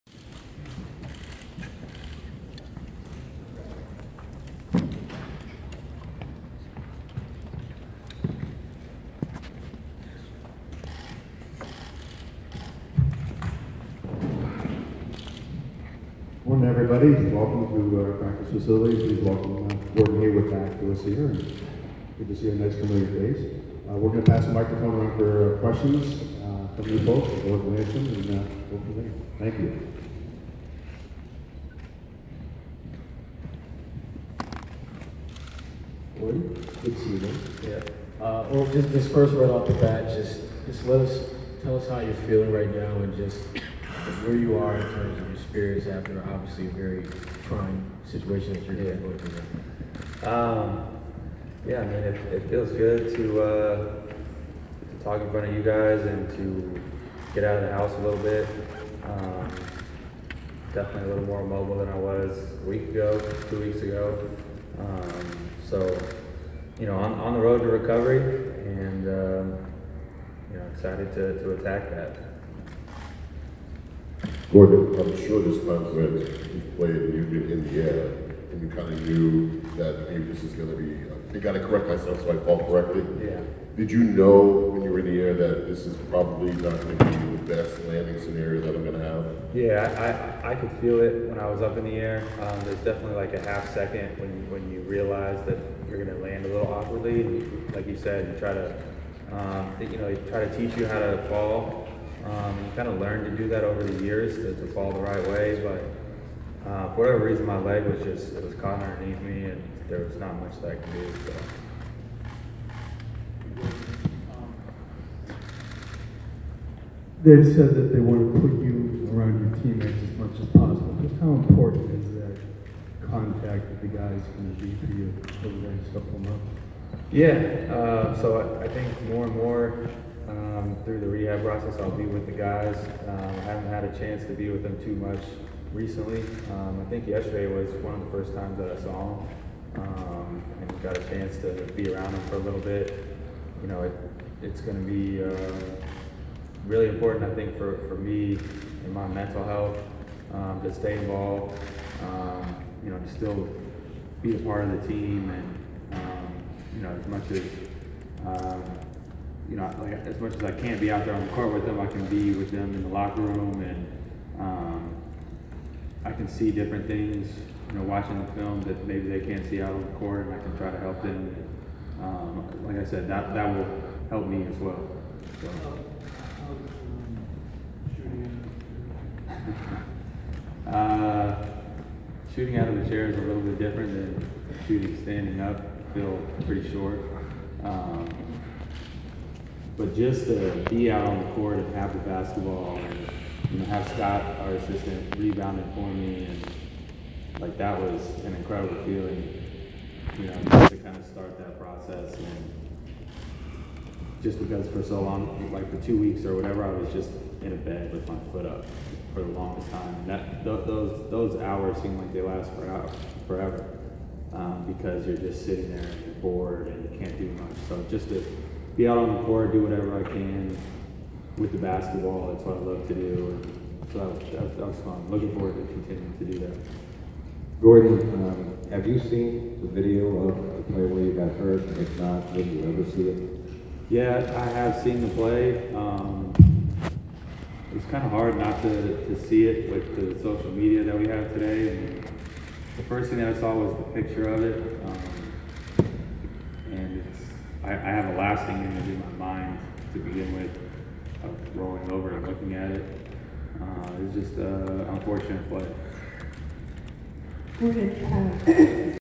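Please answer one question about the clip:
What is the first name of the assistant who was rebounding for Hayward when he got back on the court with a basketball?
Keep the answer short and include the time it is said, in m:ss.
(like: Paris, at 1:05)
Scott, at 3:13.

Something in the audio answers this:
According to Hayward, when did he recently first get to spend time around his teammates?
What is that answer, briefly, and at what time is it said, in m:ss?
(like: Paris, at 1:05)
yesterday, at 2:17.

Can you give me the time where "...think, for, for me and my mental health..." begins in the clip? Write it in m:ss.
2:27.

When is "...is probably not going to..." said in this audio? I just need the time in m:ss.
1:25.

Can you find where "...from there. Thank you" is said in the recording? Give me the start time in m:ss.
0:28.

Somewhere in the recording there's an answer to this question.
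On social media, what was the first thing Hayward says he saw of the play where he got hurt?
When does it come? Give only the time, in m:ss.
4:03.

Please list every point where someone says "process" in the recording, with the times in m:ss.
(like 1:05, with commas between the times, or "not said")
2:11, 3:21.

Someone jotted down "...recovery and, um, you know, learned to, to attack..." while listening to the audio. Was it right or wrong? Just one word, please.
wrong.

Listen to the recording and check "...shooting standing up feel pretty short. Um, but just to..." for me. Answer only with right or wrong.
right.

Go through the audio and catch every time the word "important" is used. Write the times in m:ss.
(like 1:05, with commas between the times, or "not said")
2:01, 2:26.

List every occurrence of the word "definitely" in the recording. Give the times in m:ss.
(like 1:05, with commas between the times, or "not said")
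1:00, 1:32.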